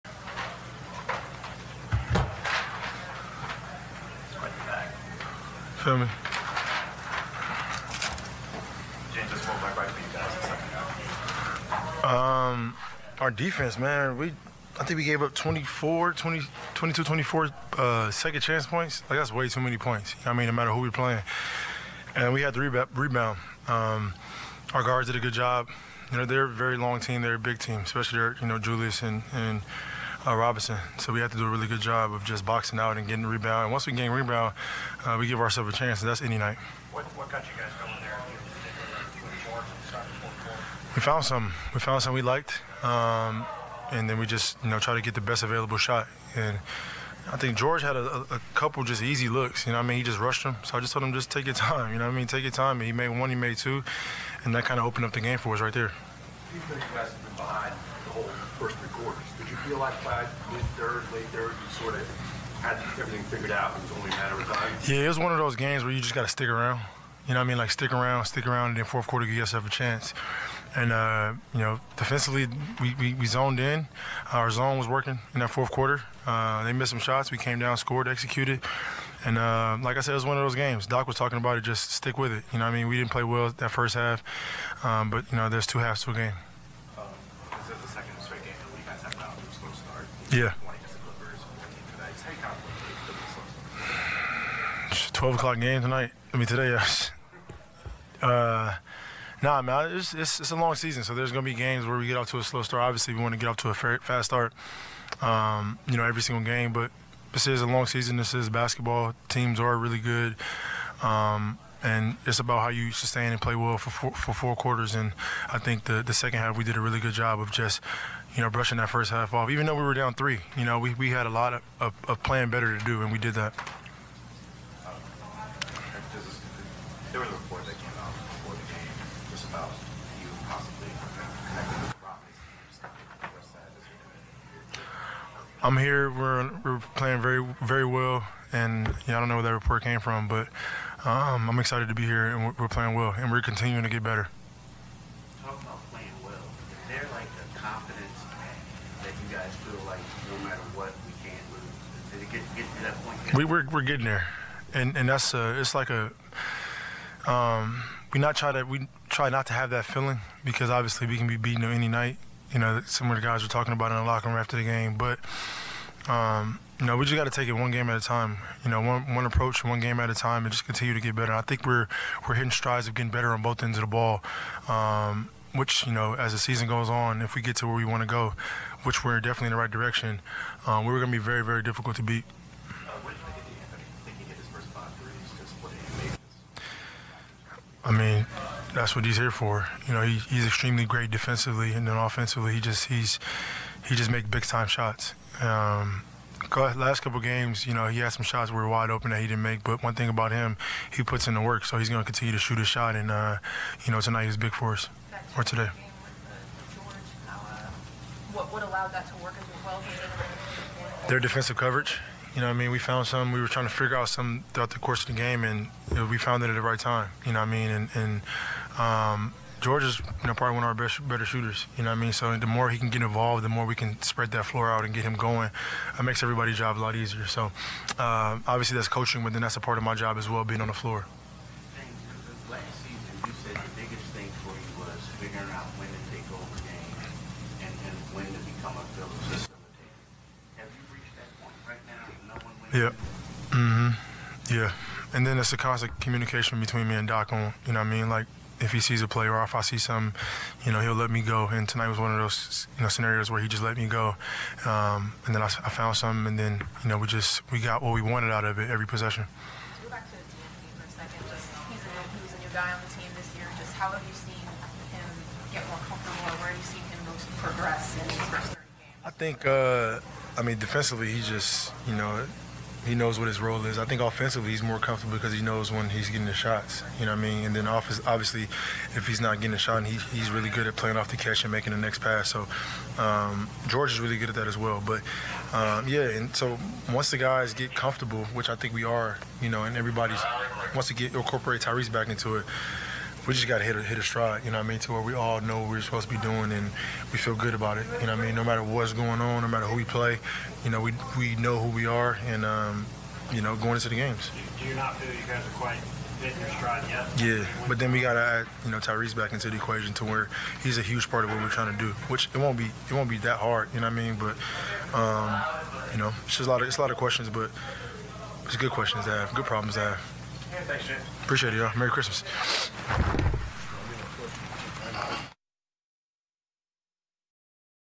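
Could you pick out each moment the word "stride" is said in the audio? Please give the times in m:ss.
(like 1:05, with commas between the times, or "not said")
2:52, 4:54, 5:06.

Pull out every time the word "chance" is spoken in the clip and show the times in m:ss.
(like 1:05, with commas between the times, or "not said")
0:18, 0:35, 1:09.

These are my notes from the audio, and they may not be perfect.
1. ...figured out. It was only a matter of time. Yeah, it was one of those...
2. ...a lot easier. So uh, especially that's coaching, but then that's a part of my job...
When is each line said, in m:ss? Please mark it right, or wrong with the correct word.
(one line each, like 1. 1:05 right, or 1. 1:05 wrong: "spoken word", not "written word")
1. 1:03 right
2. 3:46 wrong: "obviously", not "especially".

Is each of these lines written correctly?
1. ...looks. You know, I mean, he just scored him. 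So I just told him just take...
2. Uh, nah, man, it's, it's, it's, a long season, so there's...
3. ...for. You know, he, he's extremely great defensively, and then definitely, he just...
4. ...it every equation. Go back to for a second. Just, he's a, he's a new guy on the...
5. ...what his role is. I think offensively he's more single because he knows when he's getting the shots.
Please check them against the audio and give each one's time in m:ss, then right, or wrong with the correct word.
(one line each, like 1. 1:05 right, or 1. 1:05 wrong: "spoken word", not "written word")
1. 0:49 wrong: "rushed", not "scored"
2. 1:38 right
3. 3:09 wrong: "offensively", not "definitely"
4. 4:18 wrong: "possession", not "equation"
5. 4:33 wrong: "comfortable", not "single".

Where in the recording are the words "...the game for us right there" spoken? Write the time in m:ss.
0:55.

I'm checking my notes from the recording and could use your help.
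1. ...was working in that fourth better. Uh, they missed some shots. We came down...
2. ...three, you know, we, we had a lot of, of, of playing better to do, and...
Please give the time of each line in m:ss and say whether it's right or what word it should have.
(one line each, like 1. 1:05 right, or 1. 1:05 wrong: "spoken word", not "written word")
1. 1:14 wrong: "quarter", not "better"
2. 2:00 right.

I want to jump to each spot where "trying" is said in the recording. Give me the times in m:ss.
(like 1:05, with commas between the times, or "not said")
3:33, 5:11.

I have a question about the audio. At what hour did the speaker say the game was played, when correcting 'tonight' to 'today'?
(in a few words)
12 o'clock.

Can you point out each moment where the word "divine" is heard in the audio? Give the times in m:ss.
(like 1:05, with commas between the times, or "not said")
not said.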